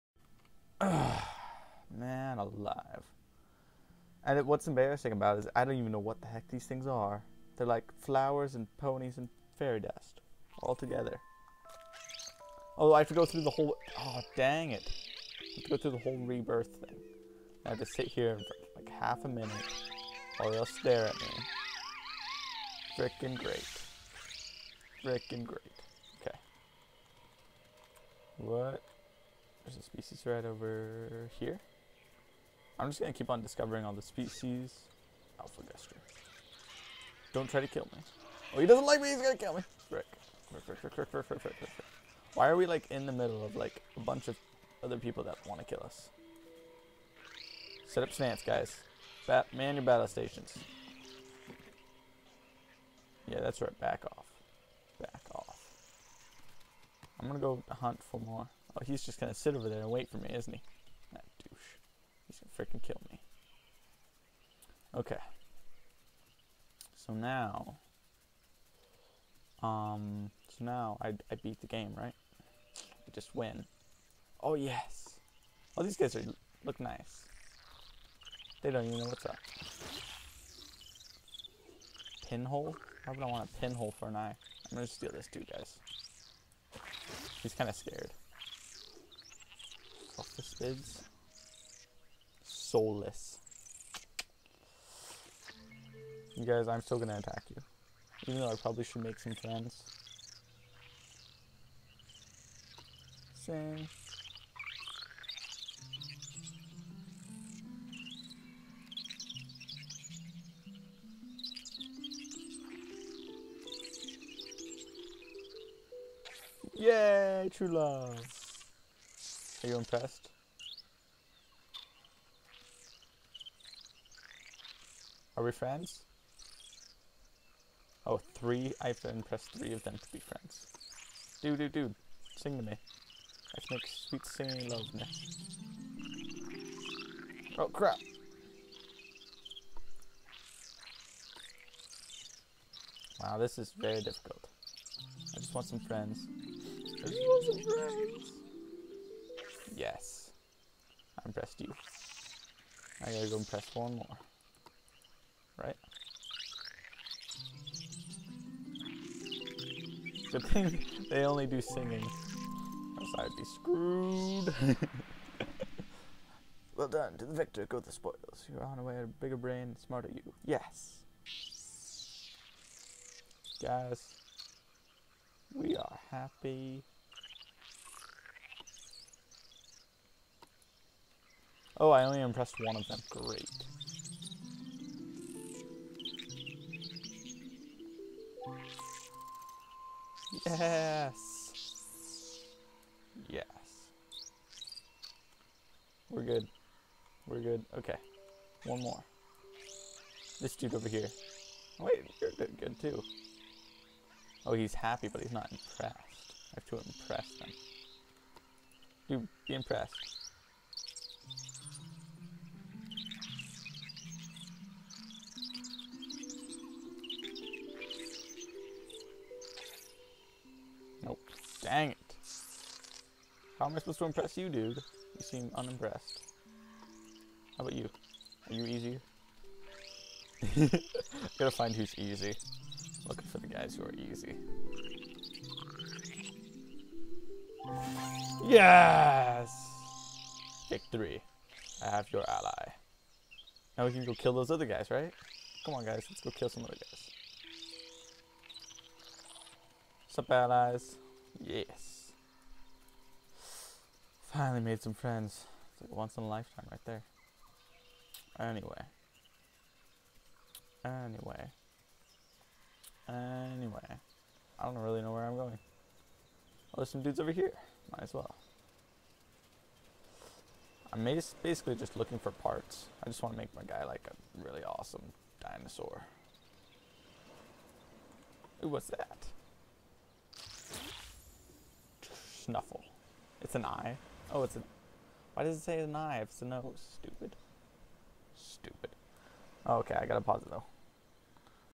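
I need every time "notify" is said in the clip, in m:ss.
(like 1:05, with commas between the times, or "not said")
not said.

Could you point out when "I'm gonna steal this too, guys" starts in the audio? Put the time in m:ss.
1:24.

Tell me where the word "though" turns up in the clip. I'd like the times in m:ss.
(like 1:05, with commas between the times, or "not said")
1:38, 4:50.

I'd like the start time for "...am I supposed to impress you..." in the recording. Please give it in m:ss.
3:43.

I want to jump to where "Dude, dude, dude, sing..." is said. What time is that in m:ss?
2:11.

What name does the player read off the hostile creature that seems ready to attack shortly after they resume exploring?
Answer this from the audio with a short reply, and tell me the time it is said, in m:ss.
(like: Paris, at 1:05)
Alpha Guster, at 0:35.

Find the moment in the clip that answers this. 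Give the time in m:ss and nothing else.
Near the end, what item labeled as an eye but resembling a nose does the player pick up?
4:42.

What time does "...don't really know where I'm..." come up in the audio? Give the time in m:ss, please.
4:24.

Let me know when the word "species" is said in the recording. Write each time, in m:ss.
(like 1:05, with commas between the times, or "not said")
0:29, 0:34.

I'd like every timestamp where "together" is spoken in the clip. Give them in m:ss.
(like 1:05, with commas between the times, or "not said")
0:10.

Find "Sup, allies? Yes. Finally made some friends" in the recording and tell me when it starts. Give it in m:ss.
4:10.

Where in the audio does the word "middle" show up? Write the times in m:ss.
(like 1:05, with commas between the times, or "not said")
0:43.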